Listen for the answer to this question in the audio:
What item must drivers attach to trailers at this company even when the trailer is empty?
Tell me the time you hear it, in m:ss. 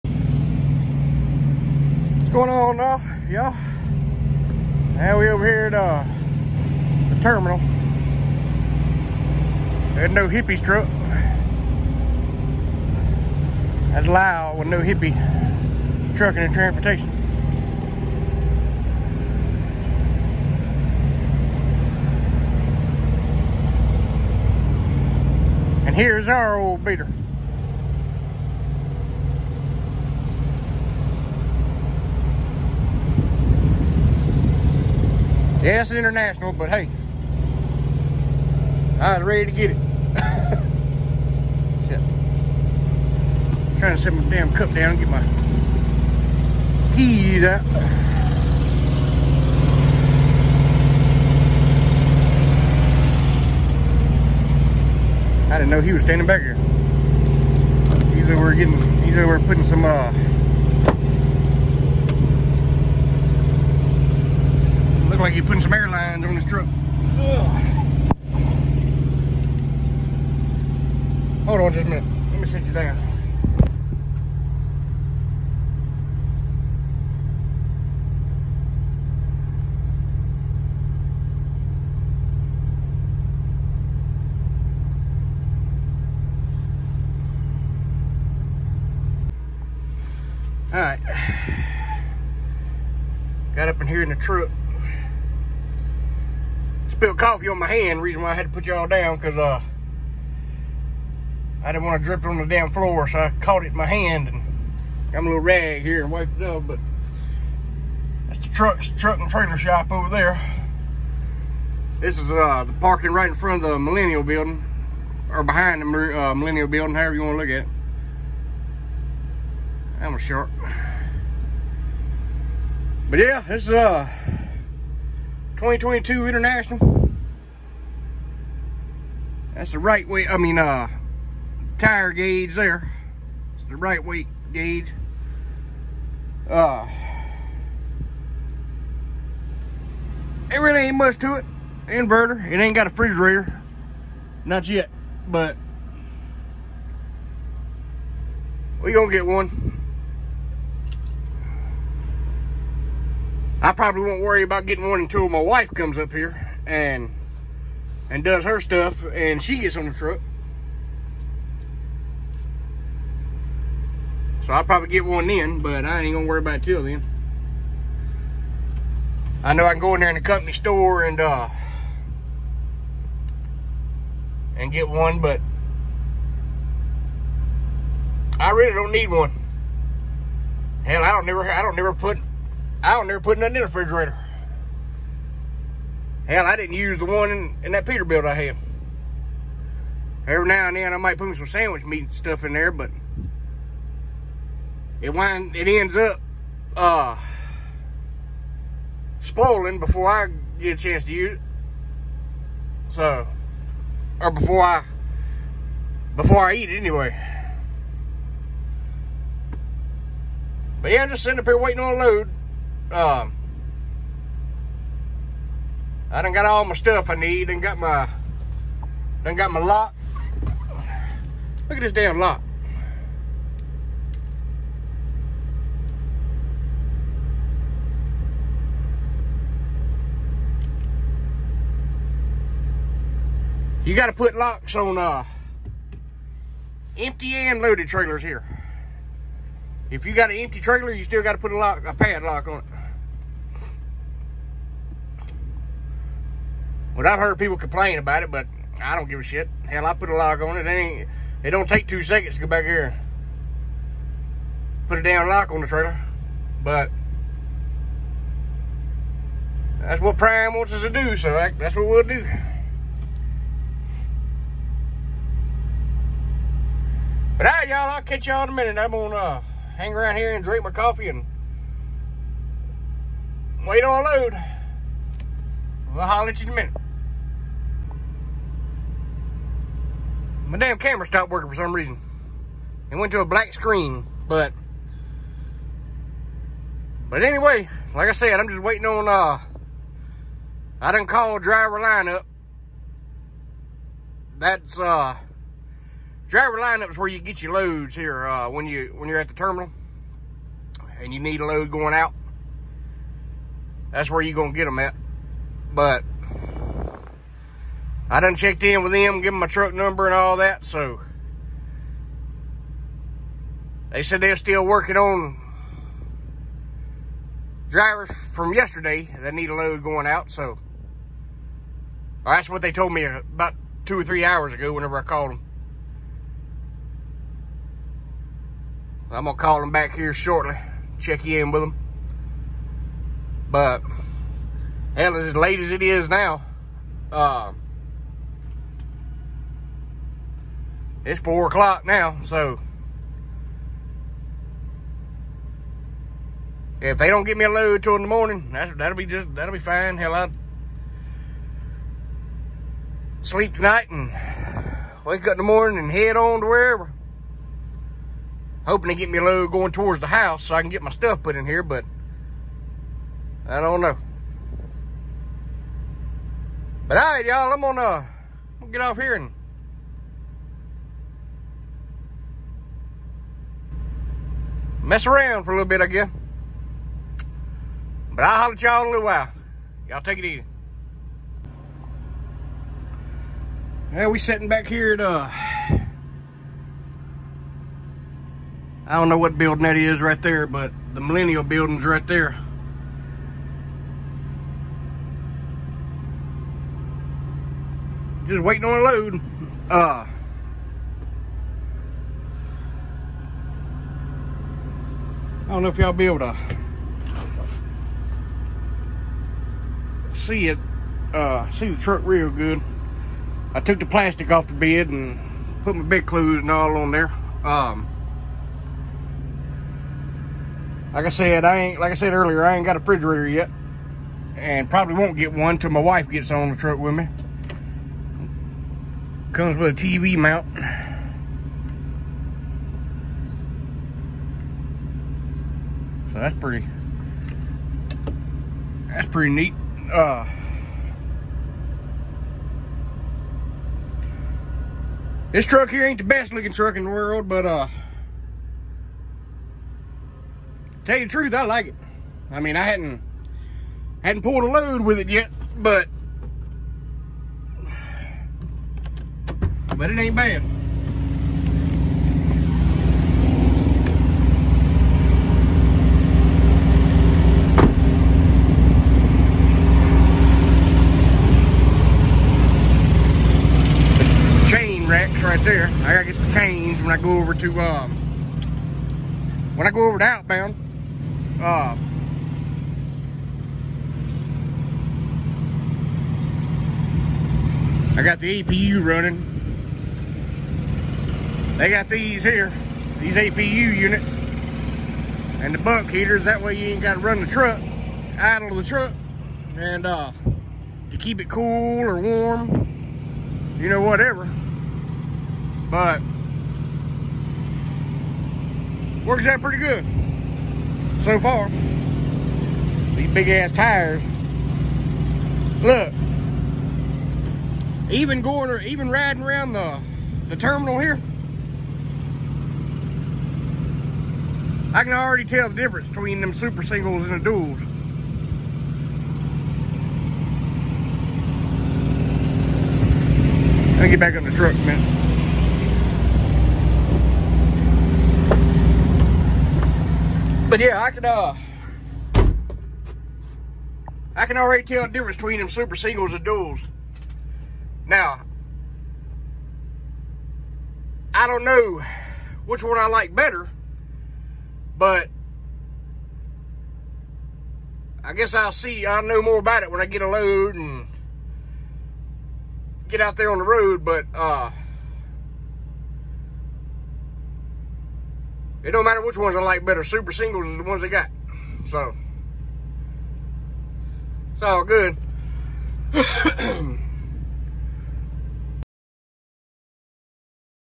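4:01.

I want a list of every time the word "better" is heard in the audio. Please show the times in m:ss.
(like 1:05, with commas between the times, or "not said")
9:13, 9:29.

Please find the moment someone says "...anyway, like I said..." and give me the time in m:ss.
4:47.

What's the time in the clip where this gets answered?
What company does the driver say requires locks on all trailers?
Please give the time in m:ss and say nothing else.
4:20.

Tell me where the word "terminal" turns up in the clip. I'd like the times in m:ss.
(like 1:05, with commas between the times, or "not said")
0:07, 4:59, 8:40.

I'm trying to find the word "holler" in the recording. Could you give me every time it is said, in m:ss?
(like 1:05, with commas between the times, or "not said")
4:36, 6:18.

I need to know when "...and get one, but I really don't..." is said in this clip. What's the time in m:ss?
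2:54.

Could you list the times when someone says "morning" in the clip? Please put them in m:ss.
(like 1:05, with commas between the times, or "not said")
5:48, 5:55.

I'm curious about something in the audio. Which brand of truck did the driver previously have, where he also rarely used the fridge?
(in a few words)
Peterbilt.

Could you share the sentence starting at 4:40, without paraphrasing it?
my damn camera stopped working for some reason.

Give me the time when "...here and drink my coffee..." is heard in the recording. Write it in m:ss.
4:30.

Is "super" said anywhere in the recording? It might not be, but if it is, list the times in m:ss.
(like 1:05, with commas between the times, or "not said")
8:46, 9:05, 9:29.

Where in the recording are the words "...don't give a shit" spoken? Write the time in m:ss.
4:08.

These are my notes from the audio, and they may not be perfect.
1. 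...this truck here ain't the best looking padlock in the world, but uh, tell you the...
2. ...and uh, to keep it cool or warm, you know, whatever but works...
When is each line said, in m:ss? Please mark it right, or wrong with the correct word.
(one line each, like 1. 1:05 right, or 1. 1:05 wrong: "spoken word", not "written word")
1. 7:25 wrong: "truck", not "padlock"
2. 8:19 right.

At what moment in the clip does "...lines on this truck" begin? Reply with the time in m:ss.
1:05.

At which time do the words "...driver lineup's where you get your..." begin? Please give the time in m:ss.
4:56.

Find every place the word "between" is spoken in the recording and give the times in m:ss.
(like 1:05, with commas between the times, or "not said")
8:45, 9:05.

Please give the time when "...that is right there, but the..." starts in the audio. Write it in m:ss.
6:29.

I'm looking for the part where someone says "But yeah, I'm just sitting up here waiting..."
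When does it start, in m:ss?
3:30.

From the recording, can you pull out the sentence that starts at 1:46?
But that's the truck, truck and trailer shop over there.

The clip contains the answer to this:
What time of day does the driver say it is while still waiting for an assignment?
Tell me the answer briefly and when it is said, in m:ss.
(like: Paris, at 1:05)
4 o'clock, at 5:41.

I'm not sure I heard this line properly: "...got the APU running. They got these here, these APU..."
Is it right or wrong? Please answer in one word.
right.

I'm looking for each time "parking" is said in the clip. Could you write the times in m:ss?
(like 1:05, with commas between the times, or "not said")
1:52.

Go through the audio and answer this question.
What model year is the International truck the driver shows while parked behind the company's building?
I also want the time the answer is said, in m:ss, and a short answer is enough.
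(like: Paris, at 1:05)
2022, at 2:05.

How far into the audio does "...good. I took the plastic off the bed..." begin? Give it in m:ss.
6:52.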